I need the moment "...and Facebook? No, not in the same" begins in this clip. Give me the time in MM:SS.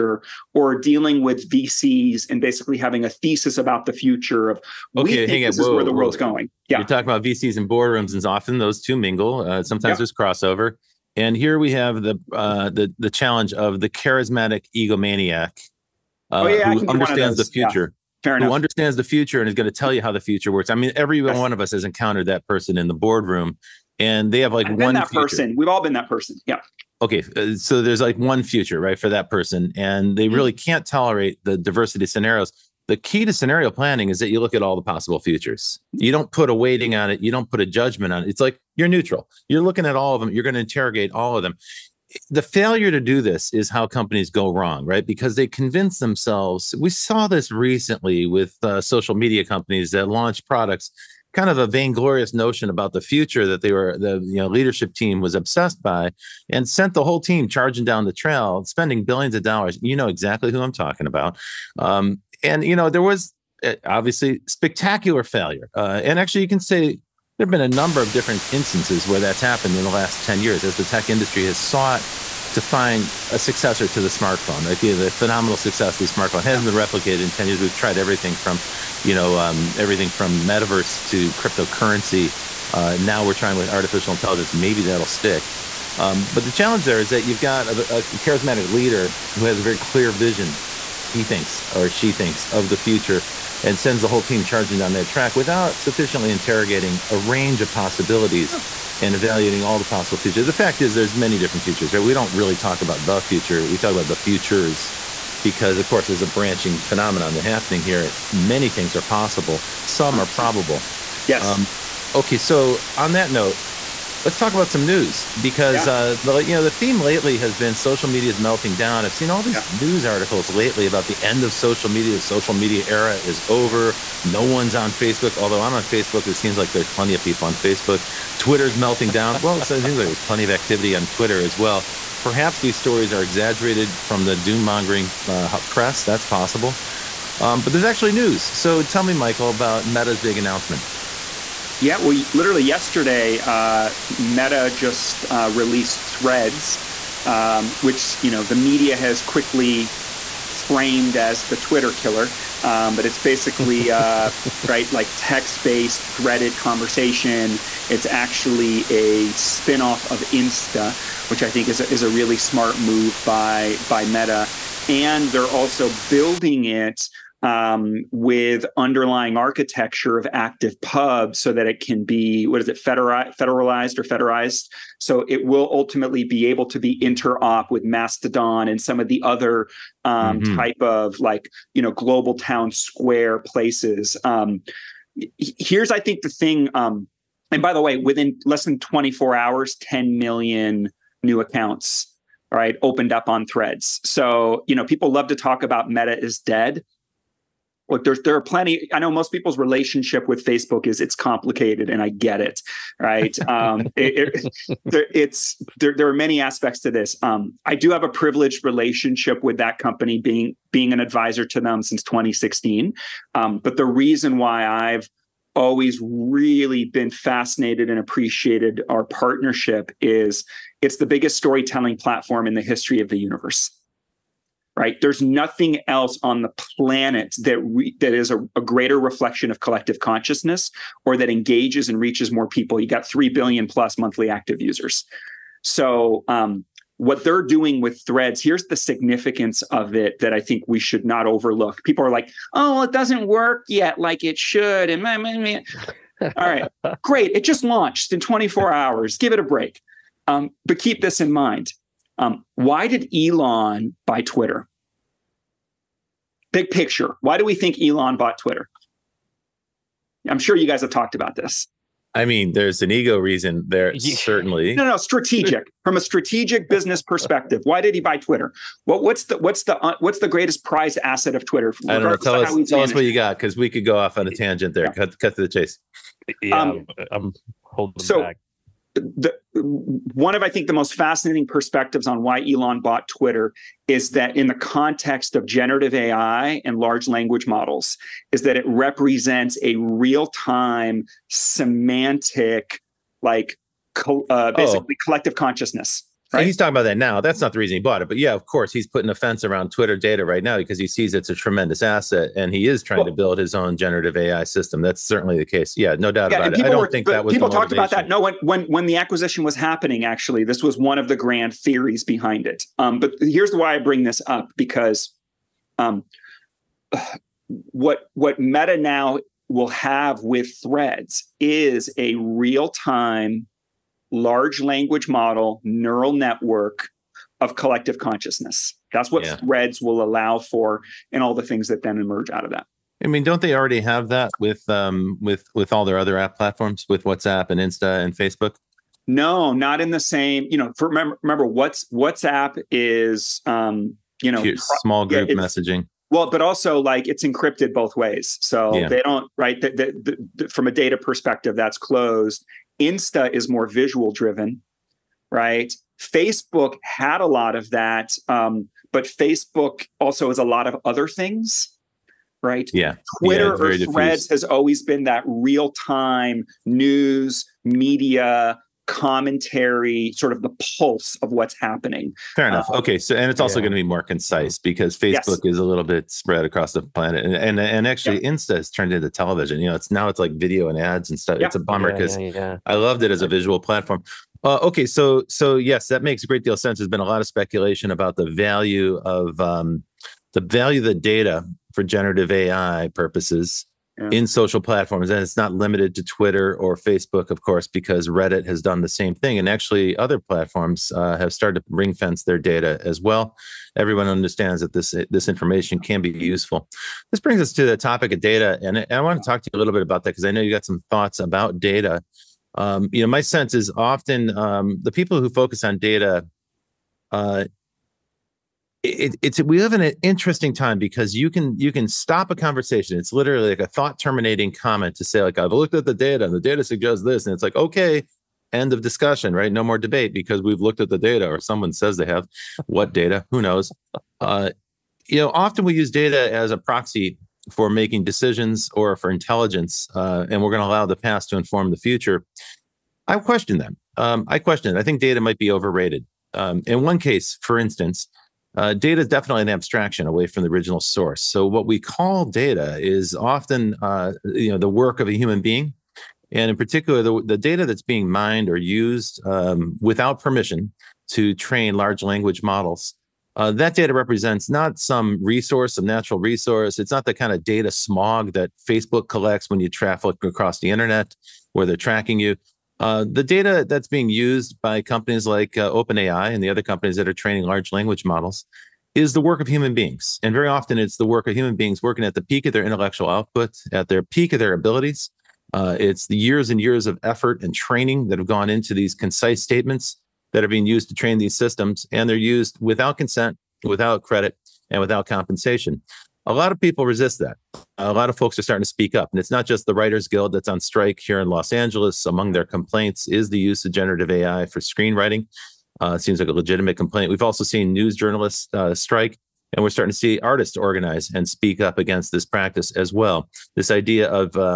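05:38.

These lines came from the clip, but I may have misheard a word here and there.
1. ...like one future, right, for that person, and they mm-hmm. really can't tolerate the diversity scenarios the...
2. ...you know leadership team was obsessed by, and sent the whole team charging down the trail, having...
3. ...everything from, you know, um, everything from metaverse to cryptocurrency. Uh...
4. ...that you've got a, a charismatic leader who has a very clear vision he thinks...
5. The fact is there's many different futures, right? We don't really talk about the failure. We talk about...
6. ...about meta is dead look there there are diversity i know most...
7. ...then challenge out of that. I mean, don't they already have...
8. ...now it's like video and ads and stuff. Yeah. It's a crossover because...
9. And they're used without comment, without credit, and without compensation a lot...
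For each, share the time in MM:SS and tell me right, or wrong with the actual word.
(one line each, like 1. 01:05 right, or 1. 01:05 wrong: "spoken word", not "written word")
1. 00:28 right
2. 00:54 wrong: "spending", not "having"
3. 01:17 right
4. 01:27 right
5. 01:40 wrong: "future", not "failure"
6. 03:15 wrong: "plenty", not "diversity"
7. 05:31 wrong: "emerge", not "challenge"
8. 06:19 wrong: "bummer", not "crossover"
9. 08:11 wrong: "consent", not "comment".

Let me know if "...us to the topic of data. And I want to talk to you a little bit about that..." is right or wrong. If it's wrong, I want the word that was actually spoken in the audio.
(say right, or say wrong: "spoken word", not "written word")
right.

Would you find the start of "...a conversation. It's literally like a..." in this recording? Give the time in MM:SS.
07:02.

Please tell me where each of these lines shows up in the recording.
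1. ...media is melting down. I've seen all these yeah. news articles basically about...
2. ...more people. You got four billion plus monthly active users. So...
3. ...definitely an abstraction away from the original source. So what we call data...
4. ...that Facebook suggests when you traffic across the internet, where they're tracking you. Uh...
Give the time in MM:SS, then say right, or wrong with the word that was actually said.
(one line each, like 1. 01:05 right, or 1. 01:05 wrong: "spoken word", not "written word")
1. 01:58 wrong: "lately", not "basically"
2. 03:52 wrong: "three", not "four"
3. 07:29 right
4. 07:48 wrong: "collects", not "suggests".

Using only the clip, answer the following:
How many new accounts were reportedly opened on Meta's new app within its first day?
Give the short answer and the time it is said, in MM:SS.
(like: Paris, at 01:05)
10 million, at 03:09.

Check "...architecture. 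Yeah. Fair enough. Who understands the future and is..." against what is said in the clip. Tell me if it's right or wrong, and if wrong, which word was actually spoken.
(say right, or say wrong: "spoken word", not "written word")
wrong: "future", not "architecture".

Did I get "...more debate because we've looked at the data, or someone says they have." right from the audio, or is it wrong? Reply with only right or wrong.
right.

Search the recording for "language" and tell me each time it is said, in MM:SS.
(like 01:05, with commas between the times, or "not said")
04:47, 05:24, 07:42, 07:57.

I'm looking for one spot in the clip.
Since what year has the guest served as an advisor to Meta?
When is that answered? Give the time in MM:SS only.
03:32.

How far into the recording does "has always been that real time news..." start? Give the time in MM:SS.
06:04.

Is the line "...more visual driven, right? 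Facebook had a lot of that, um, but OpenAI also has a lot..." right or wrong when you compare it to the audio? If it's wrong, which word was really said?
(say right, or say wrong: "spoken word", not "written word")
wrong: "Facebook", not "OpenAI".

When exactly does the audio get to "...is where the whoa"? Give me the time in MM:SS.
00:05.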